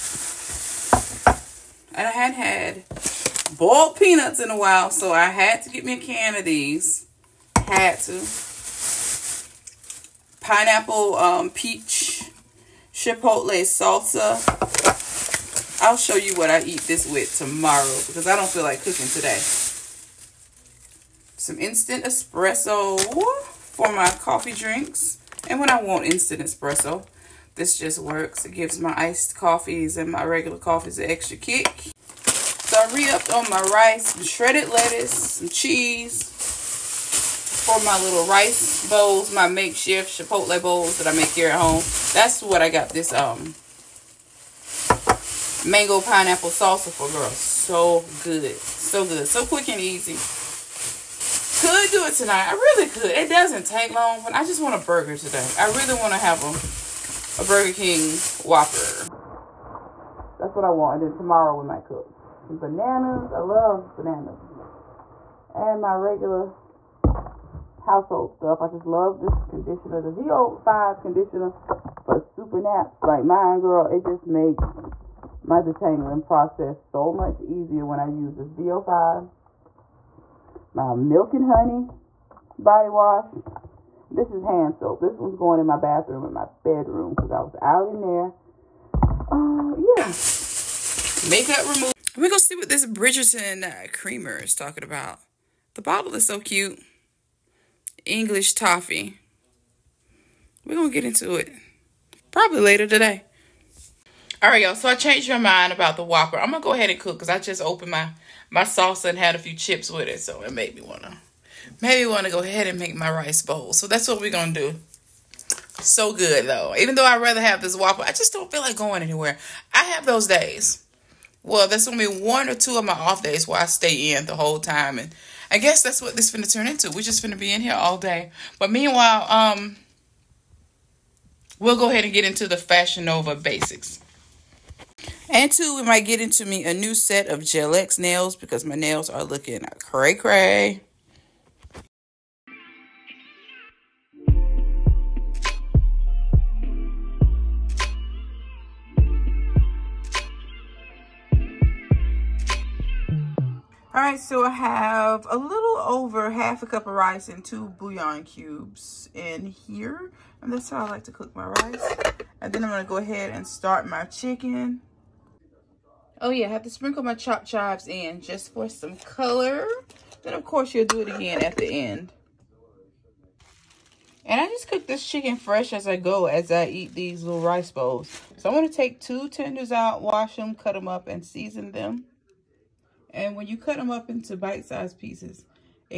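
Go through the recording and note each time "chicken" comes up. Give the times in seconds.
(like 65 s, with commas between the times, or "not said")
164 s, 175 s.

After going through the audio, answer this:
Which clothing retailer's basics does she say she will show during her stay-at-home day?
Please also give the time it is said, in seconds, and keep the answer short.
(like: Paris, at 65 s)
Fashion Nova, at 132 s.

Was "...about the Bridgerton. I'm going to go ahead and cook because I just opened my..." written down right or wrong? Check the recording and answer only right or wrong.
wrong.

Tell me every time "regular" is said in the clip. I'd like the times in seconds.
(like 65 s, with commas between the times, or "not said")
30 s, 65 s.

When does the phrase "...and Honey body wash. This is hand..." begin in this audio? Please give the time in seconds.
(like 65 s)
81 s.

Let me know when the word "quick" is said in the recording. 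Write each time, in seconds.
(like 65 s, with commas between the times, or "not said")
49 s.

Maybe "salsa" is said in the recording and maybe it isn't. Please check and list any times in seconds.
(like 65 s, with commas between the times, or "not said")
13 s, 46 s, 108 s.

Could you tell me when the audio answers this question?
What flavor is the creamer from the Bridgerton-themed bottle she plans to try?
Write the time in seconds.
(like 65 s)
98 s.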